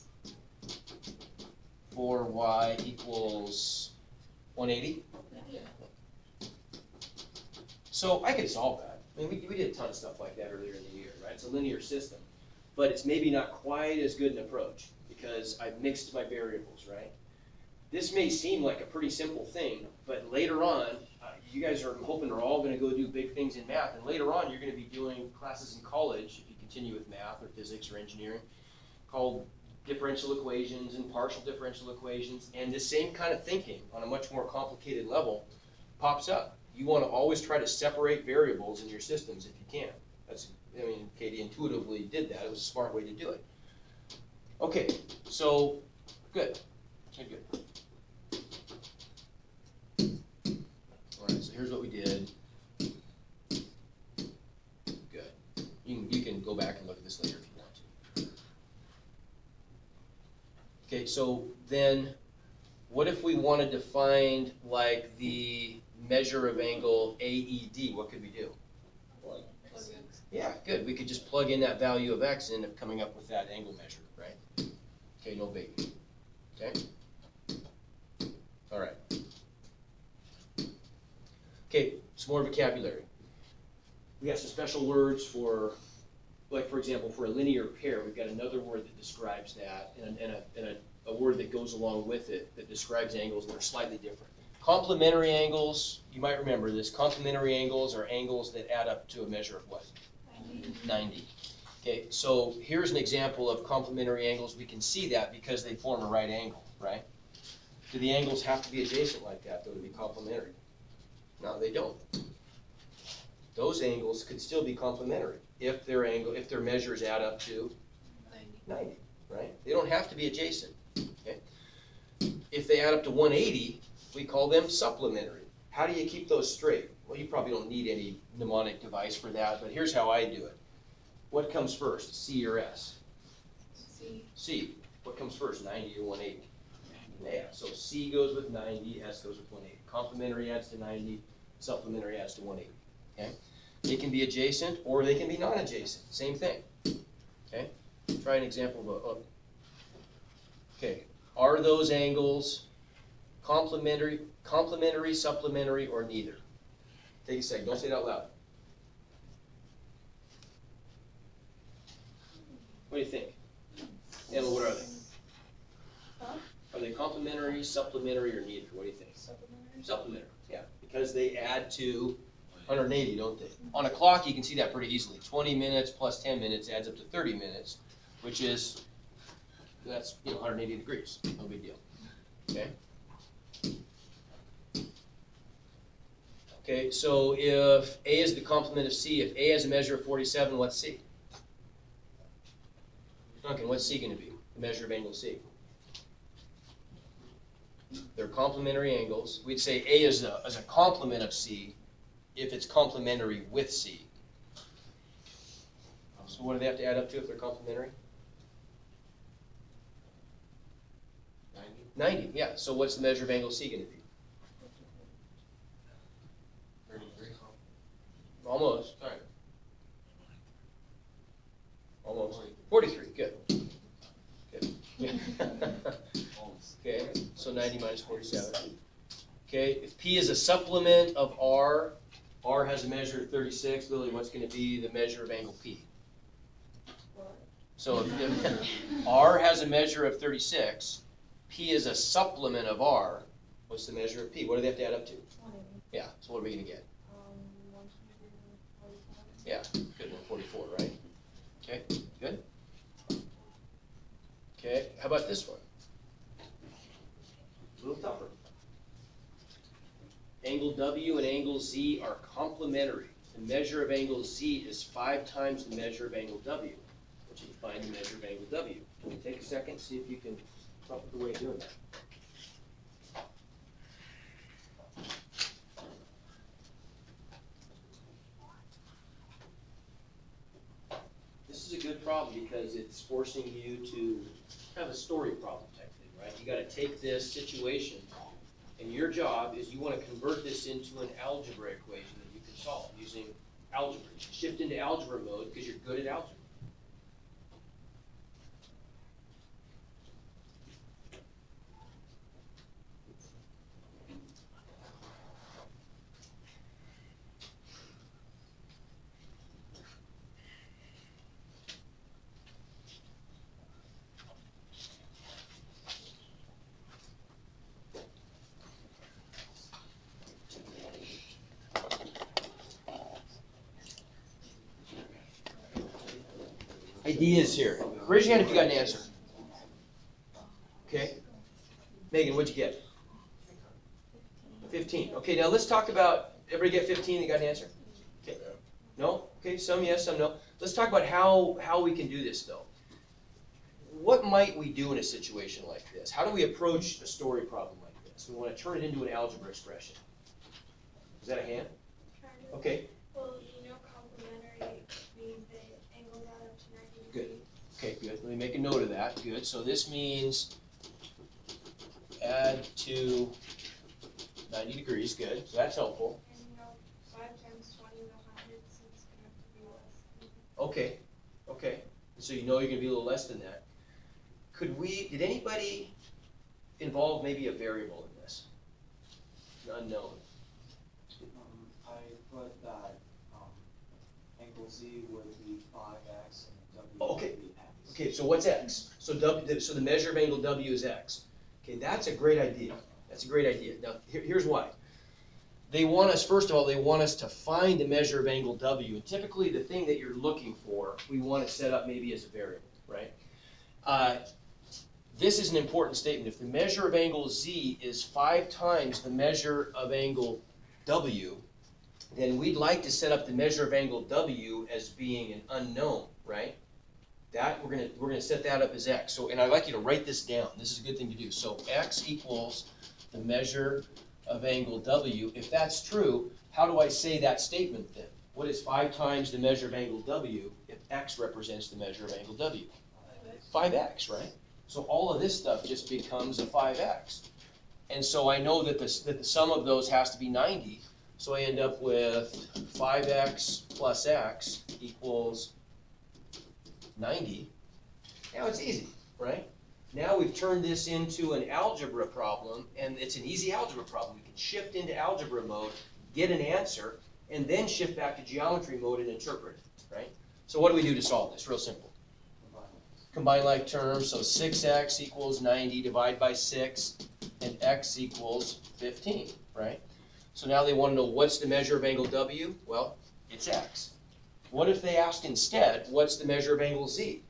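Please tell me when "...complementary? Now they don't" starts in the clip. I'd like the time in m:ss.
1:49.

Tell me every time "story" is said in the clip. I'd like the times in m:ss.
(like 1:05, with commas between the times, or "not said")
4:44, 5:47.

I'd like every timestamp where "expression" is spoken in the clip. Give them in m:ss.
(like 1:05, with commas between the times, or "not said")
5:49.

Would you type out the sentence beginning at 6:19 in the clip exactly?
An Unknown, um, I put that, um, angle Z would be five X and W.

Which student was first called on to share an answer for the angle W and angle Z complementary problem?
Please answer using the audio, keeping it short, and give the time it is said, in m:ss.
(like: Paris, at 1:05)
Megan, at 5:32.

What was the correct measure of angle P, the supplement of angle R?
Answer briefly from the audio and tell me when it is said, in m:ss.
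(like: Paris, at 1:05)
144, at 4:10.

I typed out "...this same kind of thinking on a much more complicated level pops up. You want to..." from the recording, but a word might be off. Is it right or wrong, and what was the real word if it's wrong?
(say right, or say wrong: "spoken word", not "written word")
right.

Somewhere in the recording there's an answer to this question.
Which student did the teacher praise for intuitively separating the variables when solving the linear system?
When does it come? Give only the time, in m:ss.
0:41.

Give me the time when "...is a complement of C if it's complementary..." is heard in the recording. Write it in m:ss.
3:20.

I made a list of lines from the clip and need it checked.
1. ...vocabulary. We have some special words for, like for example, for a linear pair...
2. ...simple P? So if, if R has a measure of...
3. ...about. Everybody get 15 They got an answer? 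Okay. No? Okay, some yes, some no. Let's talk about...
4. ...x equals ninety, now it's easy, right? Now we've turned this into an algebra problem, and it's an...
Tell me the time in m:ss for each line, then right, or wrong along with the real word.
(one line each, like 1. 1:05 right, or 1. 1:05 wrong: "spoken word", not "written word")
1. 1:22 right
2. 3:55 wrong: "angle", not "simple"
3. 5:35 right
4. 7:24 right.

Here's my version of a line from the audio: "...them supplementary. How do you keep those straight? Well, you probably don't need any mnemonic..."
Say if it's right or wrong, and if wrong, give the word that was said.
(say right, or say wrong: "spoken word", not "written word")
right.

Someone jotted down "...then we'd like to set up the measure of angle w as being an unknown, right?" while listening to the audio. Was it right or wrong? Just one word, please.
right.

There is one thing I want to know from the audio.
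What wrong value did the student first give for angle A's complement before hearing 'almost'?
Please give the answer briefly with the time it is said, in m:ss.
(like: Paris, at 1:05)
33, at 3:36.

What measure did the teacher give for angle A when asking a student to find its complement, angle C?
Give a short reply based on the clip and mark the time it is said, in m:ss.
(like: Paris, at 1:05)
47, at 3:10.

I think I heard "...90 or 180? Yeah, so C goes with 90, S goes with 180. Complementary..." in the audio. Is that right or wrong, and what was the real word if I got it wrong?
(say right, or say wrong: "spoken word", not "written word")
right.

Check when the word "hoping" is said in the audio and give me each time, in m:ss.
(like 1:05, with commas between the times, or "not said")
0:22.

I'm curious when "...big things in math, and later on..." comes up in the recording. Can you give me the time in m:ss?
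0:23.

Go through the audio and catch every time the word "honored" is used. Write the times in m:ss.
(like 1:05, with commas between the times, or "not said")
not said.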